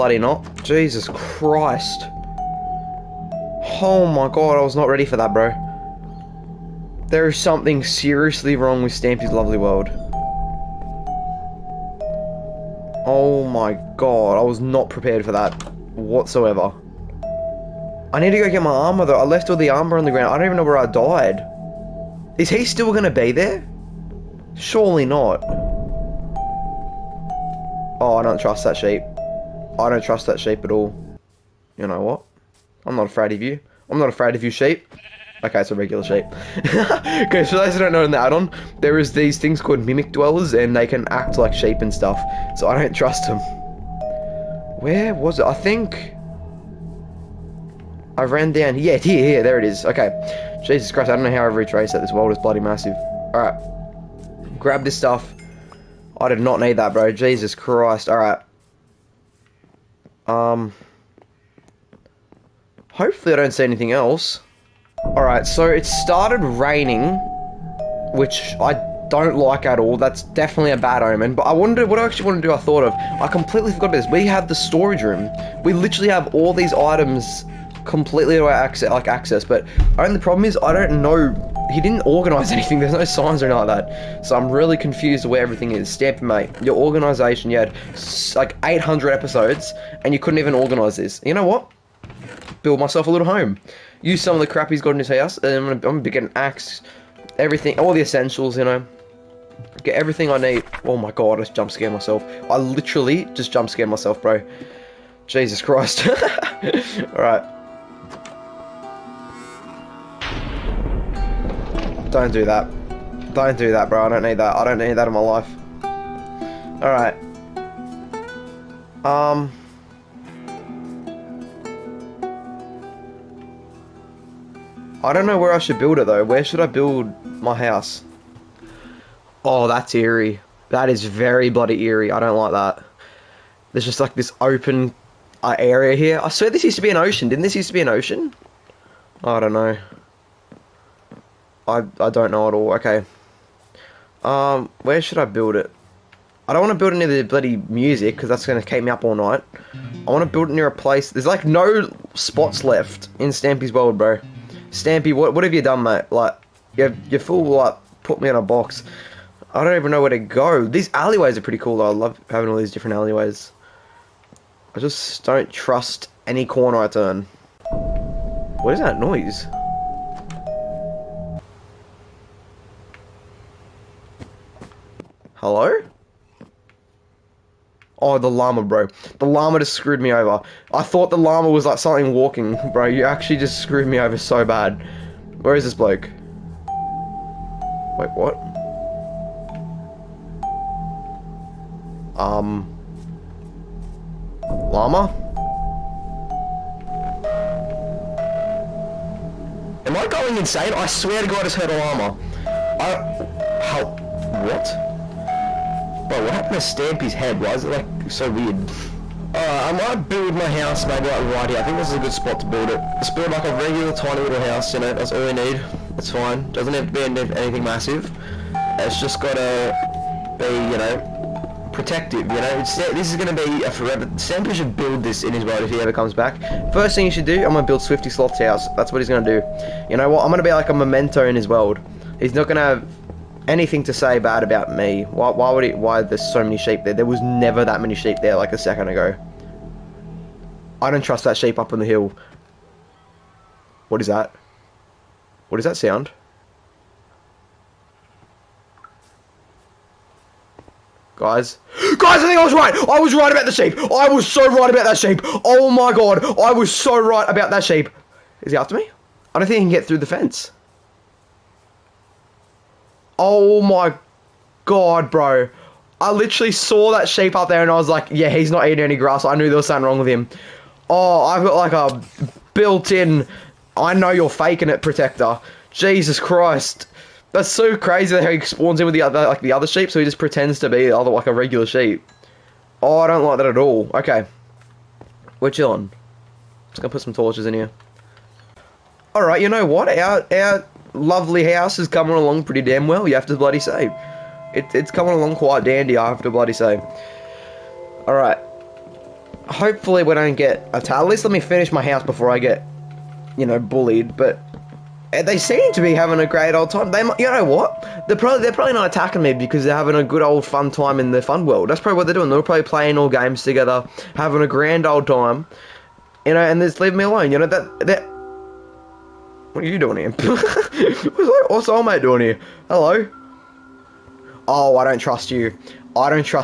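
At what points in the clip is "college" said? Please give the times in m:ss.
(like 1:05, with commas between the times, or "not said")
not said.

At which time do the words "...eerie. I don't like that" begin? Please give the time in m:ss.
2:11.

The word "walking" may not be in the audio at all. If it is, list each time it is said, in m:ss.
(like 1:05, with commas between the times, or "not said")
3:02.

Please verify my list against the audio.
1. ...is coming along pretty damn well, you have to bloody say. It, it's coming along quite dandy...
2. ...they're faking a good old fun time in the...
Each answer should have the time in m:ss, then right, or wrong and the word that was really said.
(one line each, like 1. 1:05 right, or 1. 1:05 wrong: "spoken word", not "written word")
1. 4:51 right
2. 5:09 wrong: "having", not "faking".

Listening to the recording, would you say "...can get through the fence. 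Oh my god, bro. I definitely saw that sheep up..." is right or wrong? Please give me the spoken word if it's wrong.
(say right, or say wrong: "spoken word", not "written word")
wrong: "literally", not "definitely".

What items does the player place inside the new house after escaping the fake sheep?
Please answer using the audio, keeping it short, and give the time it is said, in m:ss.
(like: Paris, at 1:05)
torches, at 4:47.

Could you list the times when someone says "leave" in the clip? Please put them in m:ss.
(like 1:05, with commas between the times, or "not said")
5:16.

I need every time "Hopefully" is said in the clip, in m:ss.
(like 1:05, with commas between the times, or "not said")
1:02, 4:59.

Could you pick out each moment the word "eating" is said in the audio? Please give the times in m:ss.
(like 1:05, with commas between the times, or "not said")
4:28.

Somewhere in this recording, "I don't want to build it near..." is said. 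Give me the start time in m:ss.
2:26.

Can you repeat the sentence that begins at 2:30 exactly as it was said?
I want to build it near a place.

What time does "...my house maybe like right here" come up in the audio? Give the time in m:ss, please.
3:30.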